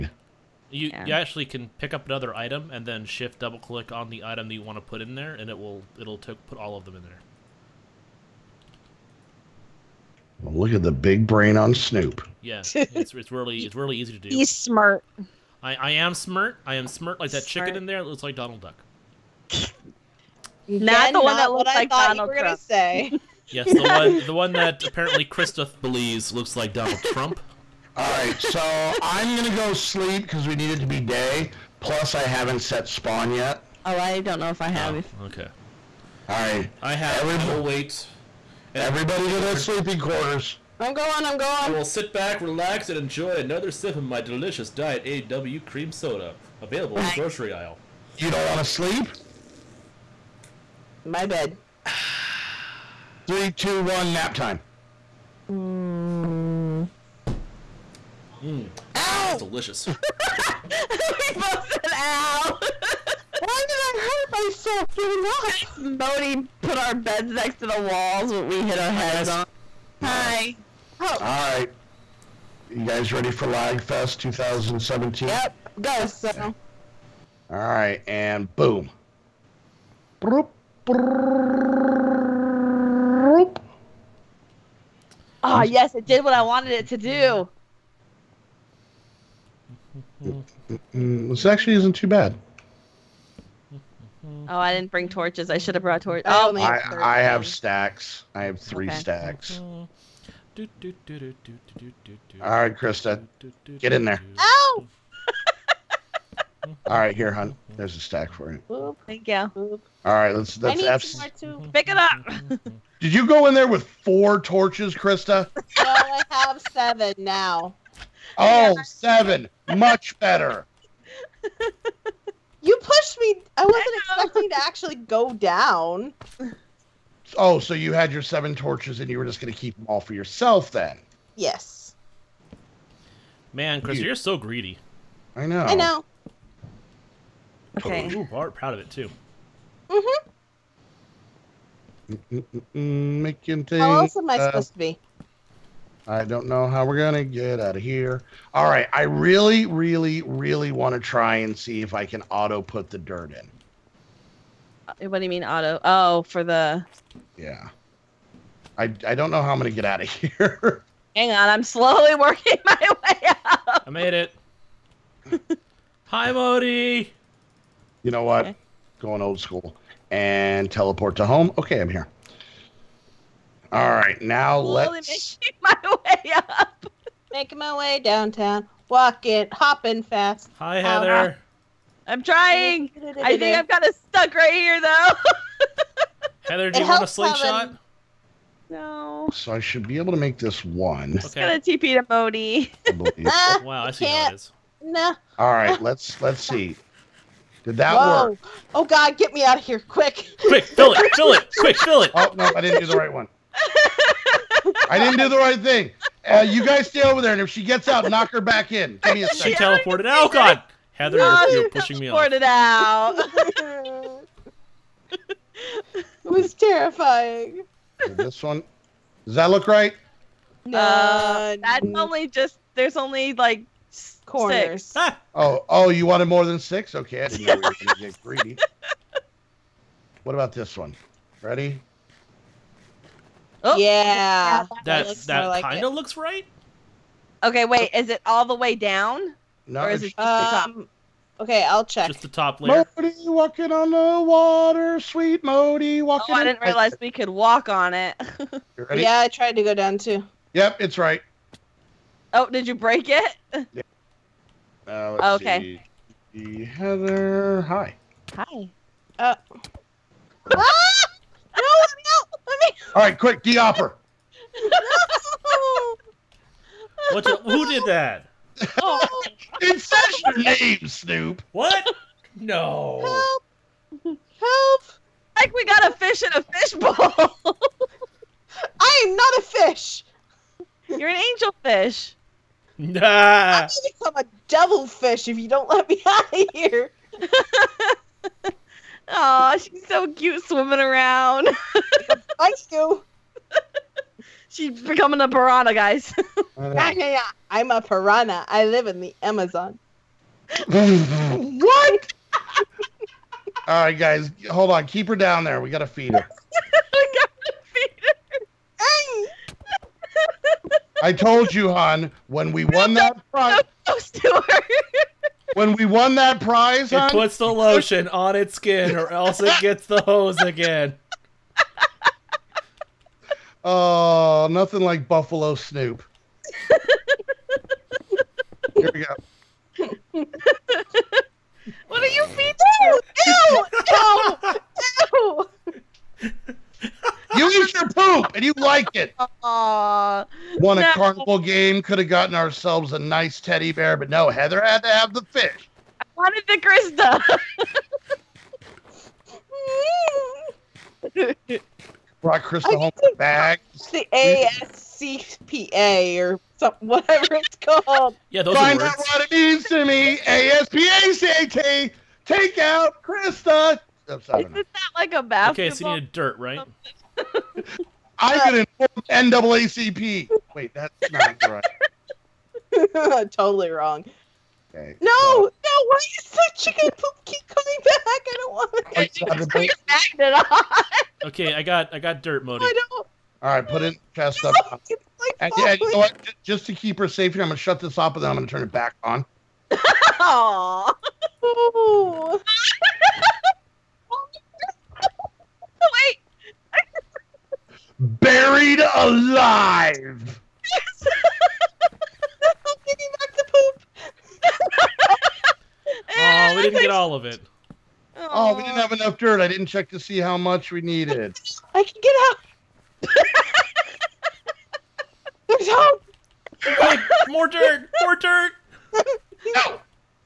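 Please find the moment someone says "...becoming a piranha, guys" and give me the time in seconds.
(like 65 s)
294 s.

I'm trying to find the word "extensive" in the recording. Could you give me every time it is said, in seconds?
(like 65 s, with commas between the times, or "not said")
not said.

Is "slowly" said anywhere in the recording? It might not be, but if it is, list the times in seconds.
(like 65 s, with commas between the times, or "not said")
161 s, 174 s.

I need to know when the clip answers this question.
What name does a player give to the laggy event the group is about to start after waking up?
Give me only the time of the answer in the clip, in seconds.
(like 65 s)
73 s.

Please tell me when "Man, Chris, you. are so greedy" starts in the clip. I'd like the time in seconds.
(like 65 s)
133 s.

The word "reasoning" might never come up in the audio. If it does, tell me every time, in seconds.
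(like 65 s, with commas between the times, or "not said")
not said.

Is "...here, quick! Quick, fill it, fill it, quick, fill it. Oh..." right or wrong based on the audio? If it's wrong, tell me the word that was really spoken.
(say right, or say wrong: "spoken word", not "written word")
right.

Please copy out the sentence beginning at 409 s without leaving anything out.
I didn't check to see how much we needed.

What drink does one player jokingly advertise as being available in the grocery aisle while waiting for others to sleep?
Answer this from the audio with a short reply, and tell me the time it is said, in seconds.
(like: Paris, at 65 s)
Diet A&W cream soda, at 44 s.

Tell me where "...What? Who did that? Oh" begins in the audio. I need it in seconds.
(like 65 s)
267 s.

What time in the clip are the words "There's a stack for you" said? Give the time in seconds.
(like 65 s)
107 s.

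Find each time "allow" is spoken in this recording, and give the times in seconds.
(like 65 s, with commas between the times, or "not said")
not said.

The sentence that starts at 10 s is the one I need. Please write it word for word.
Well, look at the big brain on Snoop.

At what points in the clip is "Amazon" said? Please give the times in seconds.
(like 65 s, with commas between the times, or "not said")
299 s.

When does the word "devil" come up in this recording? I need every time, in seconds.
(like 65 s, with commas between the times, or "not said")
284 s.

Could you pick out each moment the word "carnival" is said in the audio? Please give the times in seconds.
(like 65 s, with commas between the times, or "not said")
340 s.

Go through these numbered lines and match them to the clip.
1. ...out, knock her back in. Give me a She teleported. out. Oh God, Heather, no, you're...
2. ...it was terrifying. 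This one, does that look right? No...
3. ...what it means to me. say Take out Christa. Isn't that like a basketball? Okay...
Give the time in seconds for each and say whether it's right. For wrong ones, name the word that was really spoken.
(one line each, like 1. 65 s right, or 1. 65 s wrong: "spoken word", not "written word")
1. 207 s right
2. 215 s right
3. 358 s right.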